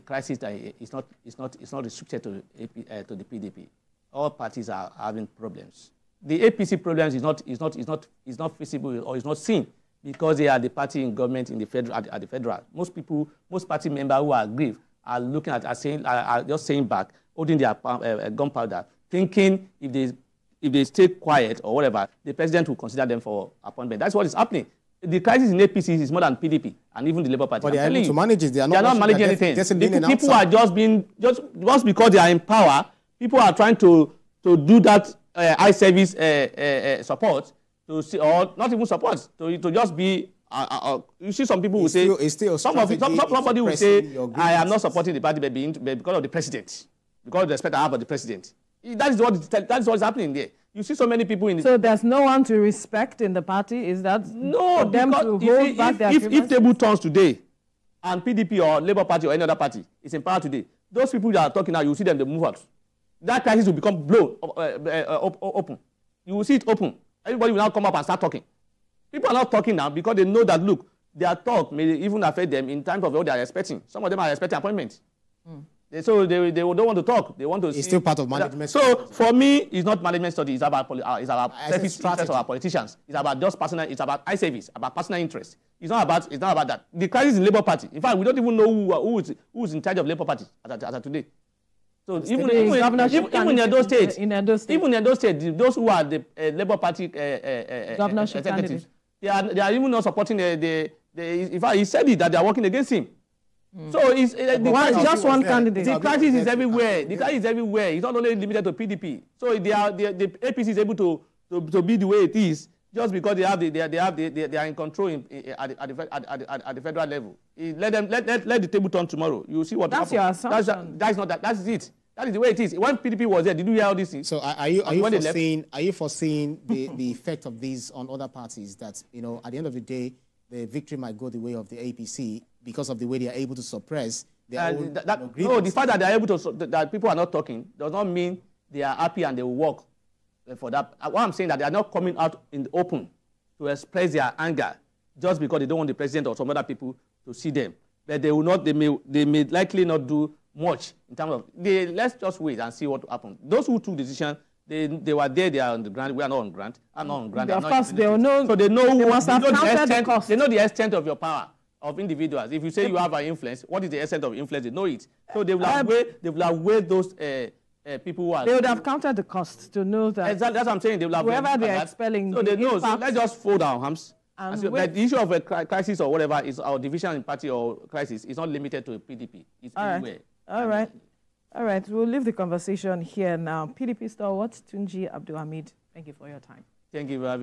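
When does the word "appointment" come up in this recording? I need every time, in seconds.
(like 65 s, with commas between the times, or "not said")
23 s, 74 s.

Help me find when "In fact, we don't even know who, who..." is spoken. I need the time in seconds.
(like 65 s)
87 s.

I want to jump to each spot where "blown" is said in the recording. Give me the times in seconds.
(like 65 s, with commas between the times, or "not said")
64 s.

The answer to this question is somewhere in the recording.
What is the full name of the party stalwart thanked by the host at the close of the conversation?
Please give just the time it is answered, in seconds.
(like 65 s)
184 s.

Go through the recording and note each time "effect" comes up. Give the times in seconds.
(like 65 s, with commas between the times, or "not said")
127 s.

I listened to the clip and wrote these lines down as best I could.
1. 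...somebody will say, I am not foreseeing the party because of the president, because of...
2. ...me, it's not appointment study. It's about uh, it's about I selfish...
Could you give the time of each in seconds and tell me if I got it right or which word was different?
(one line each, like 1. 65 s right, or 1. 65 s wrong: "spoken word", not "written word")
1. 43 s wrong: "supporting", not "foreseeing"
2. 79 s wrong: "management", not "appointment".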